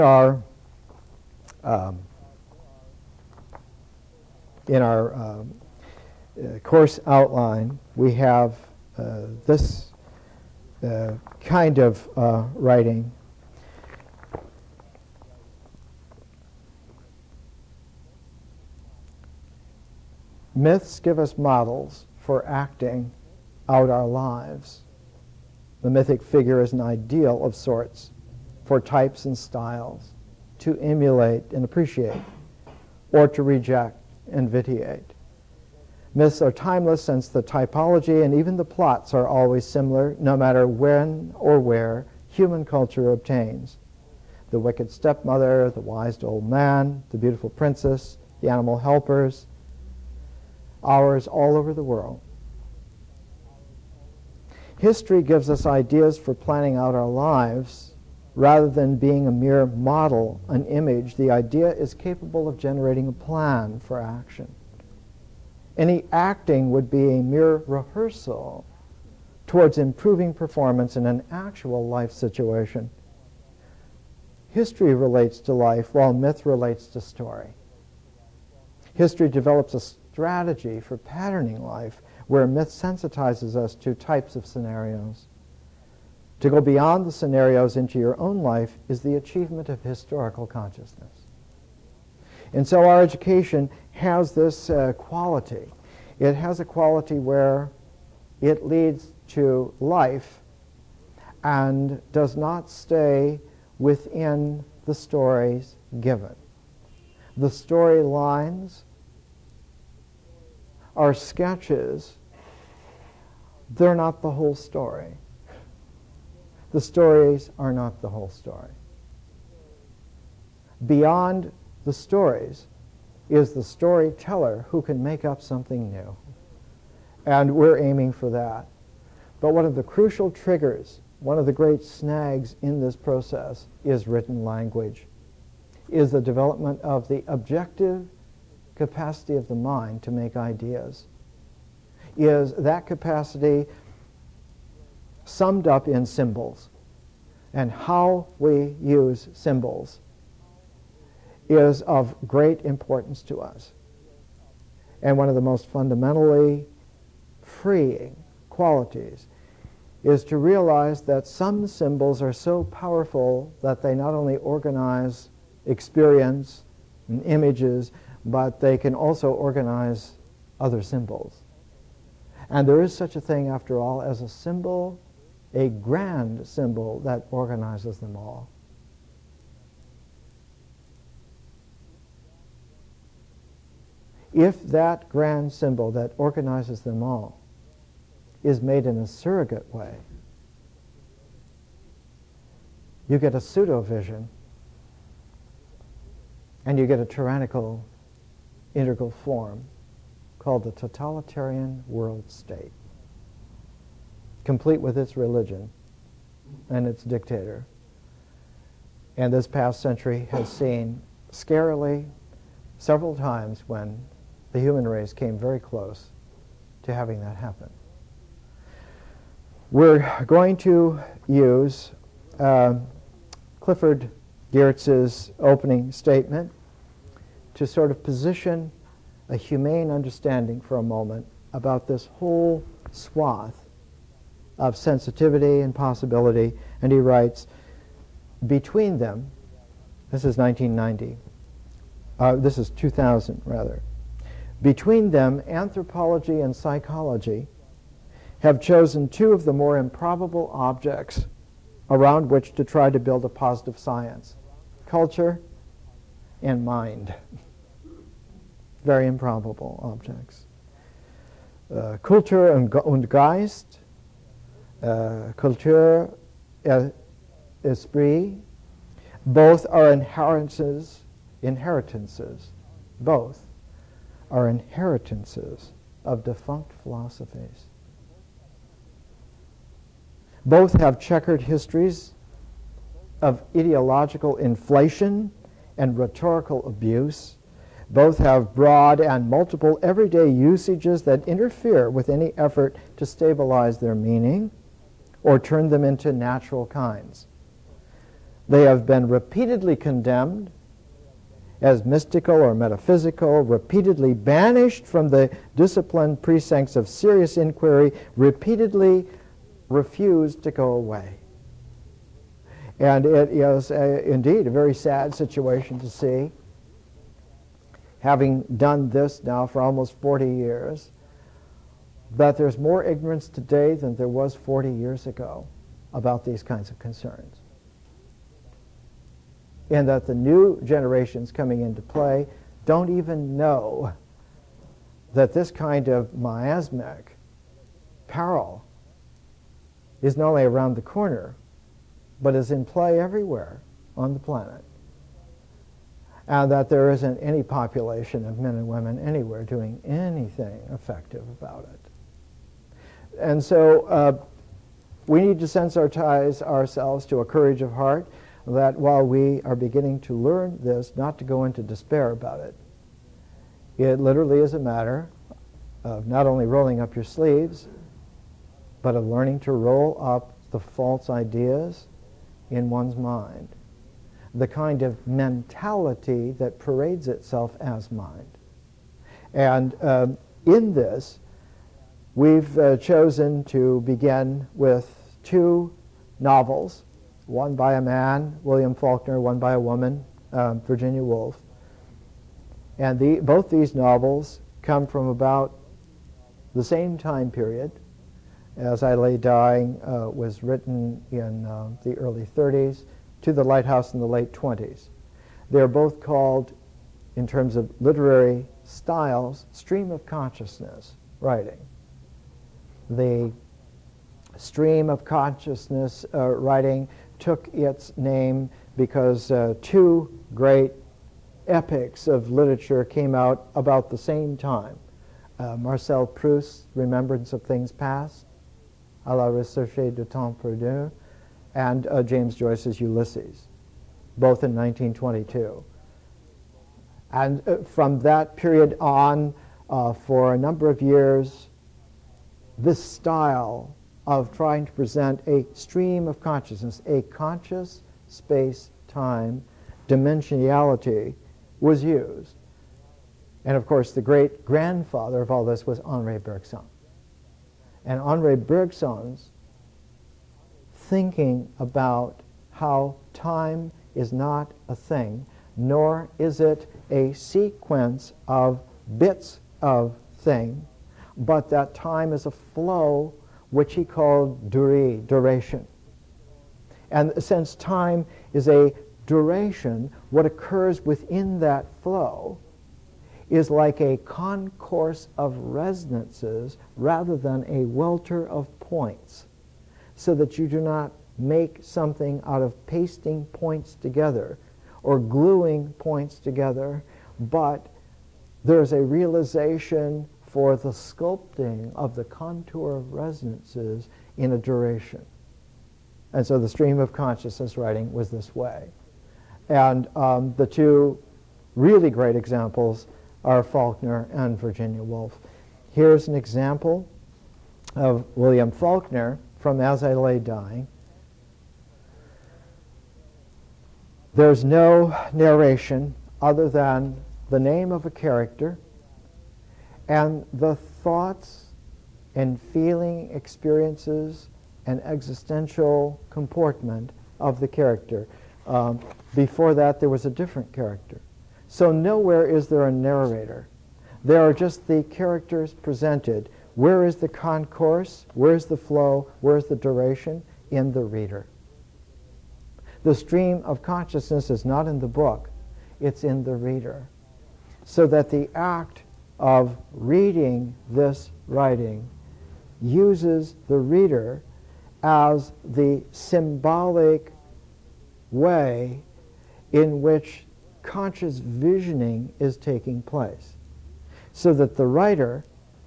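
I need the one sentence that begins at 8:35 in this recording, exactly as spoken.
Here's an example of William Faulkner from As I Lay Dying.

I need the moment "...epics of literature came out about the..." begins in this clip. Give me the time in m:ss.
7:01.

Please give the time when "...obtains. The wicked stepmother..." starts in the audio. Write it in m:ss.
0:43.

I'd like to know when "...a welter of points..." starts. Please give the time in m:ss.
8:07.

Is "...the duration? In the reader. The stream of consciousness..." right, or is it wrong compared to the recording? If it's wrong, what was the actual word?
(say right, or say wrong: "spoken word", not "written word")
right.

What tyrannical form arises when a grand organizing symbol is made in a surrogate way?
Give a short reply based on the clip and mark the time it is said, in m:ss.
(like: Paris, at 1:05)
Totalitarian world state, at 3:20.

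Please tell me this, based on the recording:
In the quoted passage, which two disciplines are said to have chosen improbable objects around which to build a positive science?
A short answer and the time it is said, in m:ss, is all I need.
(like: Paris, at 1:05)
Anthropology and psychology, at 4:05.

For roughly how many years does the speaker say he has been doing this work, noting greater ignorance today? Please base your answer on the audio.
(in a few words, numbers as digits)
40 years.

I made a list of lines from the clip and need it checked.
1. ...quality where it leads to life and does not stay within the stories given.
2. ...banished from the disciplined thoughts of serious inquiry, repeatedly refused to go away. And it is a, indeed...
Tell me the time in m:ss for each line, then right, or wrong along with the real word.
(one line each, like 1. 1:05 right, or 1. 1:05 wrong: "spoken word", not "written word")
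1. 1:36 right
2. 5:04 wrong: "precincts", not "thoughts".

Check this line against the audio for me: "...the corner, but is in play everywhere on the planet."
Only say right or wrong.
right.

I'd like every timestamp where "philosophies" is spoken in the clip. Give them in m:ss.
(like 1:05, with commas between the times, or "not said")
4:36.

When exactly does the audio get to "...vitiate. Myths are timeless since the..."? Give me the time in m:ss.
0:34.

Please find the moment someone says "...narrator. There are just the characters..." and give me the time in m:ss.
9:02.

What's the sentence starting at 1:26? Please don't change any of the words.
To go beyond the scenarios into your own life is the achievement of historical consciousness.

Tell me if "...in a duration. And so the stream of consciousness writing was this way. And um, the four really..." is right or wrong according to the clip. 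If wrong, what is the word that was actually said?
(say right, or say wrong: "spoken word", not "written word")
wrong: "two", not "four".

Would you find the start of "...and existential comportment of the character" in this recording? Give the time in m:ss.
8:54.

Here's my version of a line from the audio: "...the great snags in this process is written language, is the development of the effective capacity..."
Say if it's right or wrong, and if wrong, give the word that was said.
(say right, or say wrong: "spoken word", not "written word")
wrong: "objective", not "effective".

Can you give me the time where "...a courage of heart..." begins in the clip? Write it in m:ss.
5:57.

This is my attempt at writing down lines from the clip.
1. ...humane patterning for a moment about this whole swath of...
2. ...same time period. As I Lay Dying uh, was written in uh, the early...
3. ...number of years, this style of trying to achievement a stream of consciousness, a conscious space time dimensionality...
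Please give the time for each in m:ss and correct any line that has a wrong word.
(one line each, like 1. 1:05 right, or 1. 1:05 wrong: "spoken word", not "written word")
1. 3:49 wrong: "understanding", not "patterning"
2. 6:36 right
3. 7:20 wrong: "present", not "achievement".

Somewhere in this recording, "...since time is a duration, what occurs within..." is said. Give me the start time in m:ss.
7:57.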